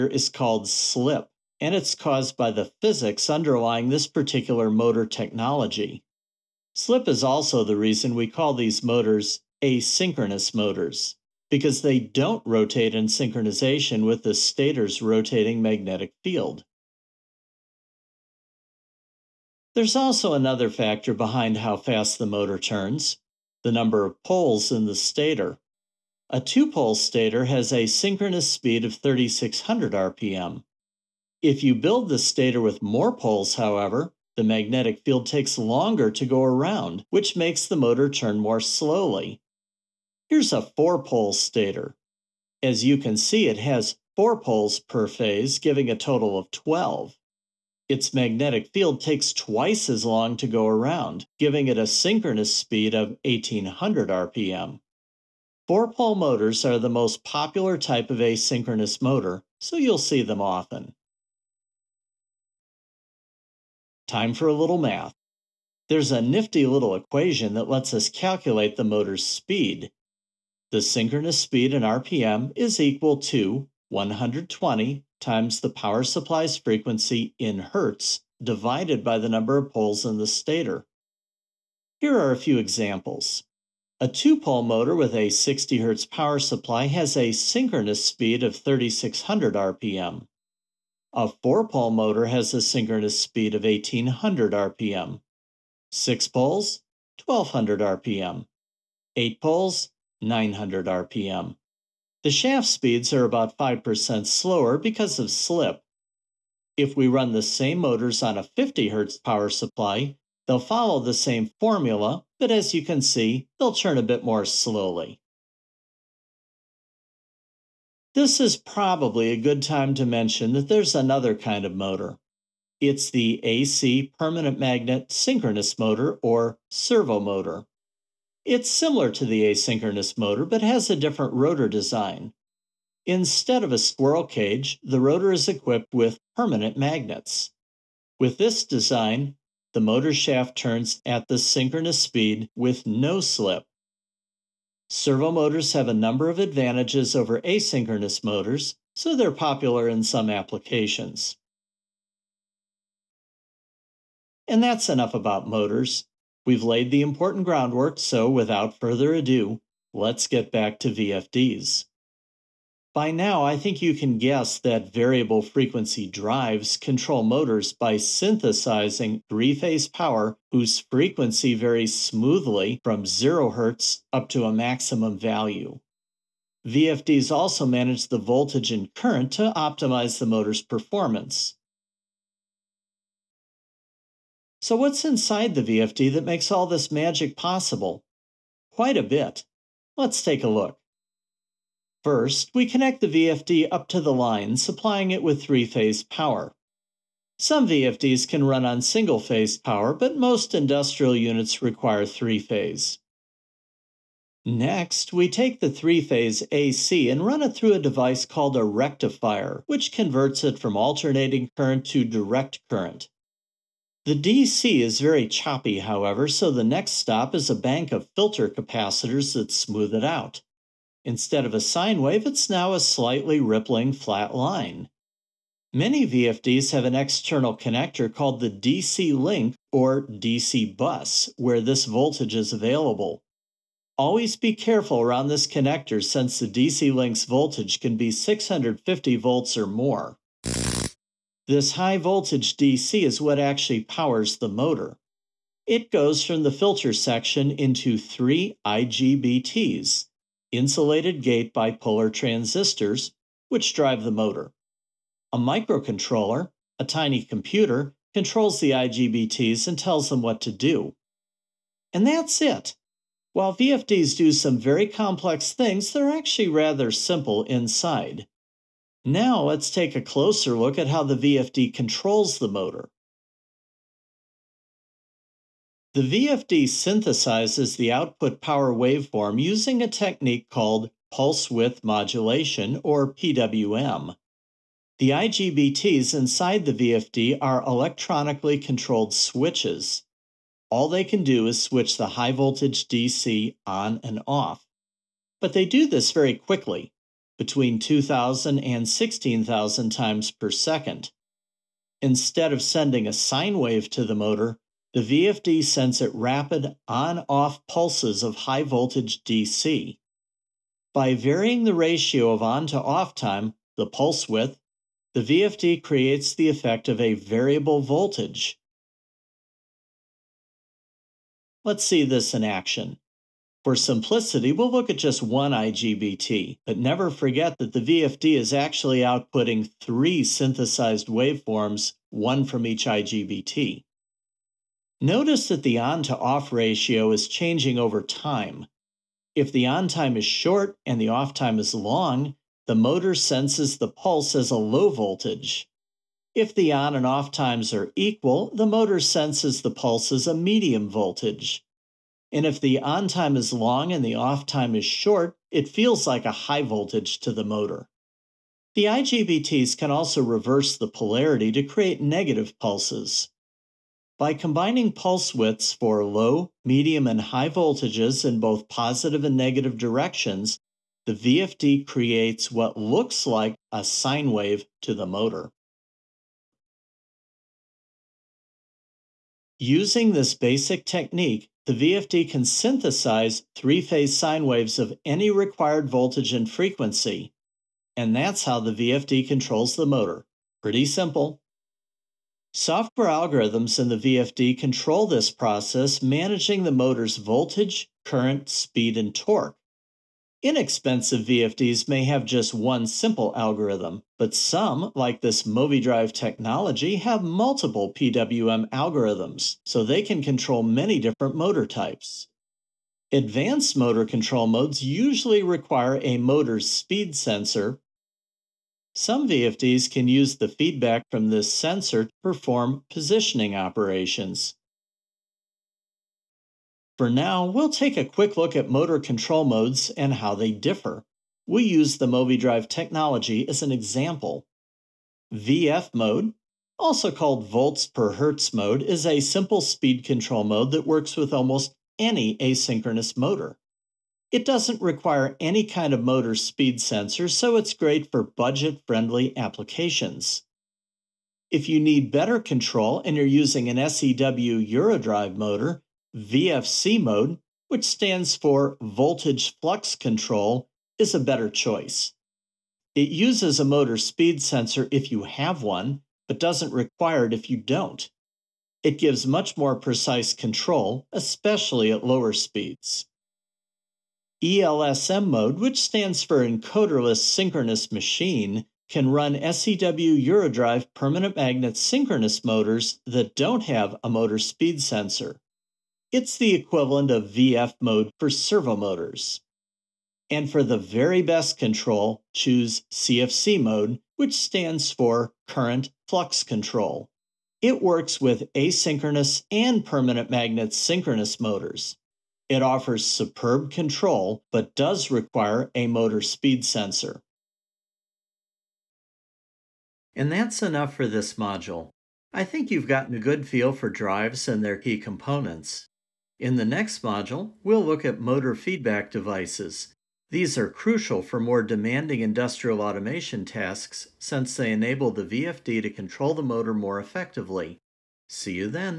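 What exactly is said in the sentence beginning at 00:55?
Four-pole motors are the most popular type of asynchronous motor, so you'll see them often.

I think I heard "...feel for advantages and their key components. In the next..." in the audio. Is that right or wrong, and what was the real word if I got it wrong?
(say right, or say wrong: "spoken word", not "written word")
wrong: "drives", not "advantages".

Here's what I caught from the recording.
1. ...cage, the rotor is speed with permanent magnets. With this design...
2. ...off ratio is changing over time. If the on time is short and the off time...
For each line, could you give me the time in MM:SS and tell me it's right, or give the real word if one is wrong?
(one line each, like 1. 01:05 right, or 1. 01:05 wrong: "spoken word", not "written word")
1. 02:14 wrong: "equipped", not "speed"
2. 05:36 right.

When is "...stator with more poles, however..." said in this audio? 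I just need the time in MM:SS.
00:32.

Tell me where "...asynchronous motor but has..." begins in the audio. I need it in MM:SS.
02:09.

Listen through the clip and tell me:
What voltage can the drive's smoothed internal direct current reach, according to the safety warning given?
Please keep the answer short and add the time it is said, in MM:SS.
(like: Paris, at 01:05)
650 volts, at 03:58.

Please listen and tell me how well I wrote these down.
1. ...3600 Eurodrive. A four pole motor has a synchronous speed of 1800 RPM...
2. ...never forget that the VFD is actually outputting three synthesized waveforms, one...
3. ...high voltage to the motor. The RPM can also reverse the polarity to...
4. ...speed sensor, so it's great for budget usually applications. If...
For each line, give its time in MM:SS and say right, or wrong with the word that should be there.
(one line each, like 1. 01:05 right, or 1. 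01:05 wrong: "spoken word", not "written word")
1. 01:28 wrong: "RPM", not "Eurodrive"
2. 05:26 right
3. 05:56 wrong: "IGBTs", not "RPM"
4. 07:26 wrong: "friendly", not "usually".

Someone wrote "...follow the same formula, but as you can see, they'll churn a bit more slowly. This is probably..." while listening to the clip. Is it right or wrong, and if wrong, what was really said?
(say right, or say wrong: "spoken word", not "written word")
right.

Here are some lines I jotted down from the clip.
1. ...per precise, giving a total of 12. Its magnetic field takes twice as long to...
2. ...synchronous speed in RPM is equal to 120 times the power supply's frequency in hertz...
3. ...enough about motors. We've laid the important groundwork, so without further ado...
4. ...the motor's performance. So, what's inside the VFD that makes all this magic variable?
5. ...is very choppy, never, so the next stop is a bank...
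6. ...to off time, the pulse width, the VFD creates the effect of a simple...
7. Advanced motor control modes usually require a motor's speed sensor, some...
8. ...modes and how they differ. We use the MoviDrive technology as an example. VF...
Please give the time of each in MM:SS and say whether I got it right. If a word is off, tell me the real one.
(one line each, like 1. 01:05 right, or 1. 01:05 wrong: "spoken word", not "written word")
1. 00:44 wrong: "phase", not "precise"
2. 01:10 right
3. 02:34 right
4. 03:00 wrong: "possible", not "variable"
5. 03:34 wrong: "however", not "never"
6. 05:12 wrong: "variable", not "simple"
7. 06:53 right
8. 07:09 right.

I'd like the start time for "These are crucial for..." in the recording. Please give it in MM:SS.
08:40.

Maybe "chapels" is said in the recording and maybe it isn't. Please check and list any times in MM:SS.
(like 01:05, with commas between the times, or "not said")
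not said.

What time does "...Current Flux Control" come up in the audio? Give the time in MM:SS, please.
08:15.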